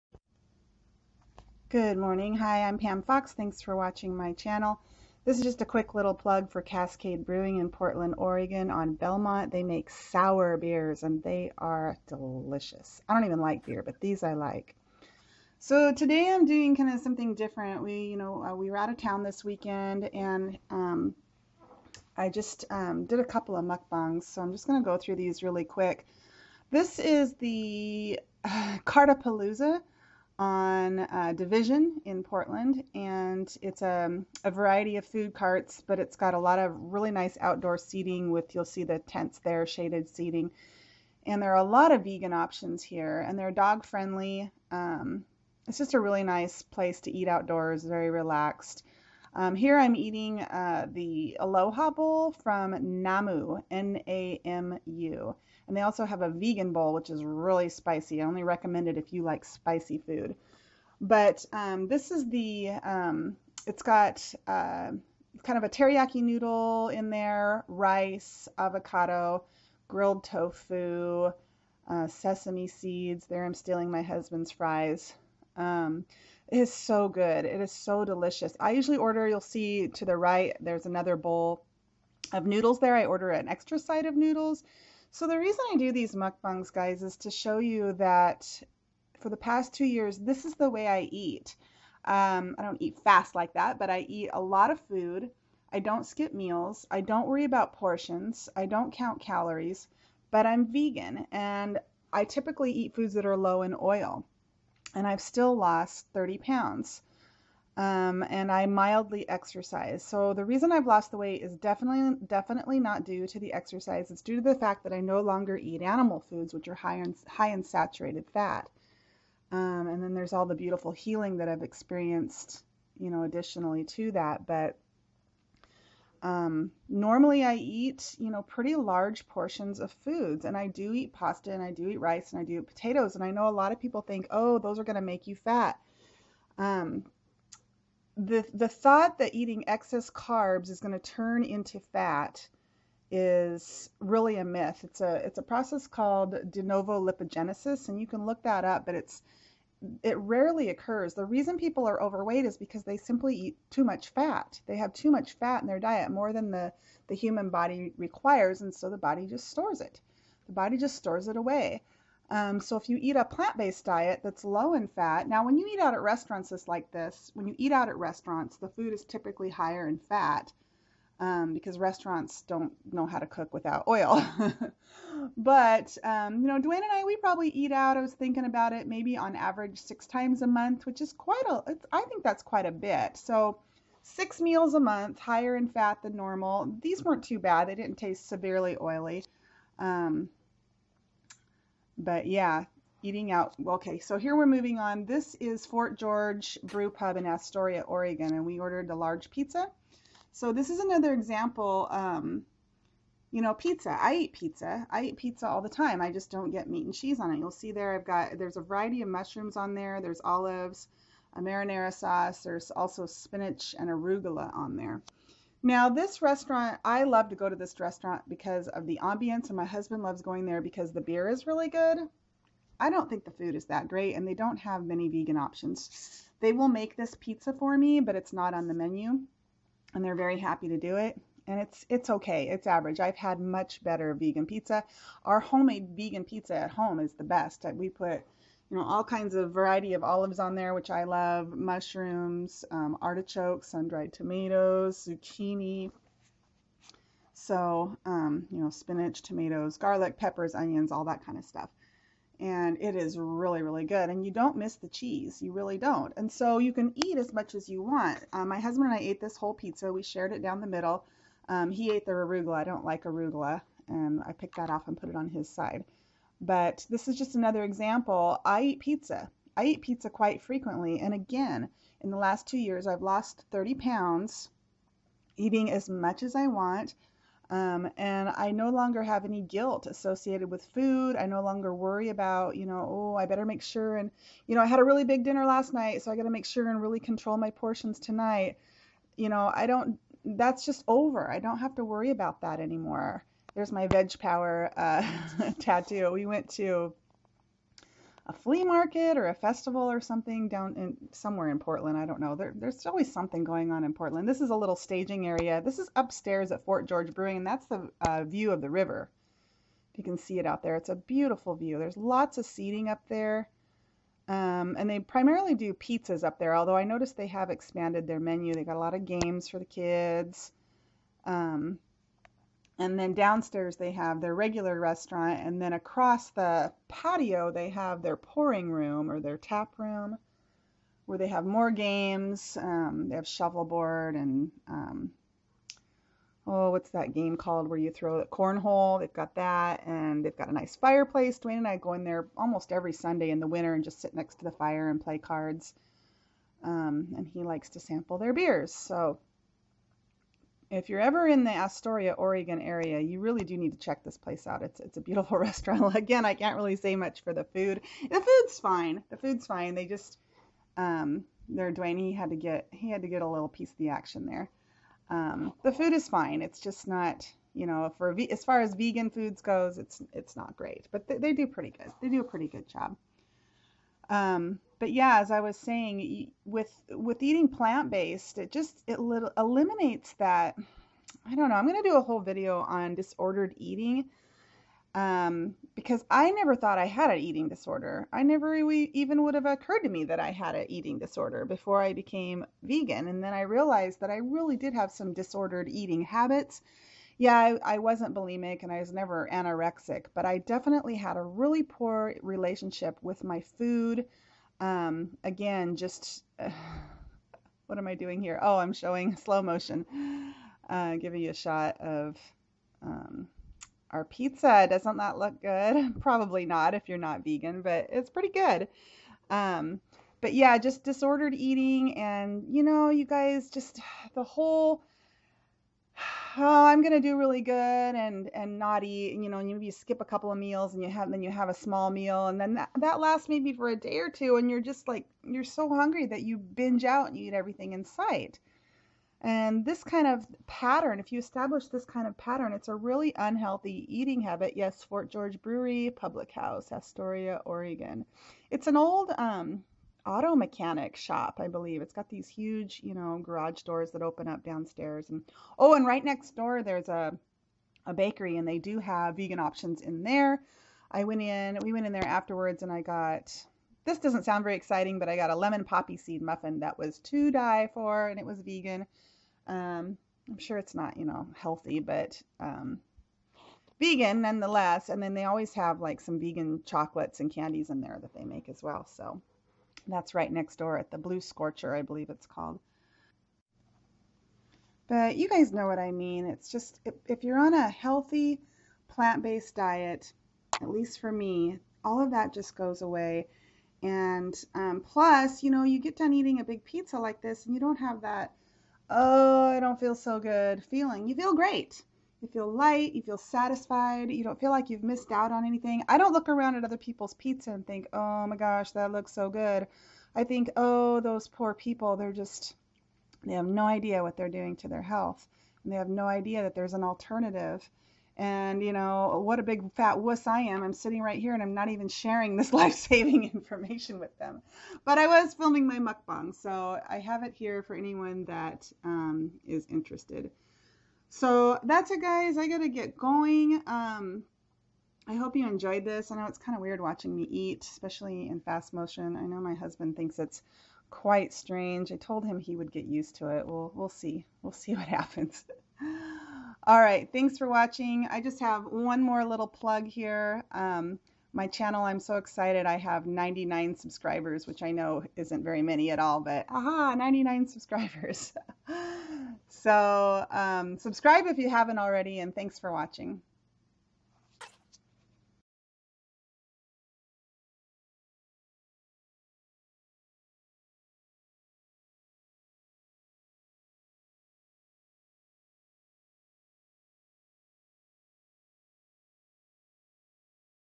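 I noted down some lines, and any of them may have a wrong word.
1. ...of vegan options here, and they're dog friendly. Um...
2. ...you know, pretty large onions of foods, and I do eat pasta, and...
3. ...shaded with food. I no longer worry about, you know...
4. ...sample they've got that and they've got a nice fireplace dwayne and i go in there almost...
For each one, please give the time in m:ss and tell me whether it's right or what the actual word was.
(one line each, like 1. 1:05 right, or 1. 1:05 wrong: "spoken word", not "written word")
1. 0:41 right
2. 2:08 wrong: "portions", not "onions"
3. 4:39 wrong: "associated", not "shaded"
4. 5:38 wrong: "cornhole", not "sample".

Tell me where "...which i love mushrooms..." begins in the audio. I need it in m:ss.
4:00.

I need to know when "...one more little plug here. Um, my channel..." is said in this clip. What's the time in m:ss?
9:08.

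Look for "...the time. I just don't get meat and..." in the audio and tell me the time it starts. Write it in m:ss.
3:25.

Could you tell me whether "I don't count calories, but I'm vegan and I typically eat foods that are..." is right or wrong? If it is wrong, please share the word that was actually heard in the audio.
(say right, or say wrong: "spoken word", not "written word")
right.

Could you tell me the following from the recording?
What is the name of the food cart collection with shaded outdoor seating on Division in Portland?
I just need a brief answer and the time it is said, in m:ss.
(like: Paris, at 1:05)
Cart-a-palooza, at 0:28.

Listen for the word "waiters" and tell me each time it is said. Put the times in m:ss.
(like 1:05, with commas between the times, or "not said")
not said.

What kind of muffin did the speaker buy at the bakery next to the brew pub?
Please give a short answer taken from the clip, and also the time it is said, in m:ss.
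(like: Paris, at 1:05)
Lemon poppy seed, at 7:45.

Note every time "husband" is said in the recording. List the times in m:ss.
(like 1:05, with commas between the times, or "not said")
1:14, 3:39, 4:18, 8:59.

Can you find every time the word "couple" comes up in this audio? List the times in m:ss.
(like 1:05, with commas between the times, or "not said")
0:23, 7:10.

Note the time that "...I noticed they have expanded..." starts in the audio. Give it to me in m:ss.
5:16.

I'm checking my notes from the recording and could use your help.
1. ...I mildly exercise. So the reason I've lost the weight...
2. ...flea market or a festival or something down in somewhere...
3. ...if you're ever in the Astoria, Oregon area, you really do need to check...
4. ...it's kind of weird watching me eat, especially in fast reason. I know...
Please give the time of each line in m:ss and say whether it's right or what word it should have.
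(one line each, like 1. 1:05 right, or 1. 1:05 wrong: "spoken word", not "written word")
1. 1:48 right
2. 4:58 right
3. 5:50 right
4. 8:56 wrong: "motion", not "reason".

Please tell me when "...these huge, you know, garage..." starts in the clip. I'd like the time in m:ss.
7:32.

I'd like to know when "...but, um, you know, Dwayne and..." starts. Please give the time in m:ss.
2:55.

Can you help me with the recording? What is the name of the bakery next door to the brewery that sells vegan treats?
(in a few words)
Blue Scorcher.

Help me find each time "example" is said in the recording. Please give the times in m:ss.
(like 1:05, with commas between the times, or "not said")
3:21, 4:27.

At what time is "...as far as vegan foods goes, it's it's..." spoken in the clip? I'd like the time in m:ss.
6:08.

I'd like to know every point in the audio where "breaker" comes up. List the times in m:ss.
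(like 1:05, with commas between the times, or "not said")
not said.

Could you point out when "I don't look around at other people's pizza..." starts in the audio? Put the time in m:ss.
8:25.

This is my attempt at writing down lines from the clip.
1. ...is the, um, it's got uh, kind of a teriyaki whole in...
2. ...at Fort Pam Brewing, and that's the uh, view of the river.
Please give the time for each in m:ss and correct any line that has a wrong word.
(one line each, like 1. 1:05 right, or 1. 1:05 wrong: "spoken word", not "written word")
1. 1:02 wrong: "noodle", not "whole"
2. 5:06 wrong: "George", not "Pam".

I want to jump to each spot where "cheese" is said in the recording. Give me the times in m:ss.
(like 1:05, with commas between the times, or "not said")
3:26, 4:14.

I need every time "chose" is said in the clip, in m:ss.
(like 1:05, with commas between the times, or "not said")
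not said.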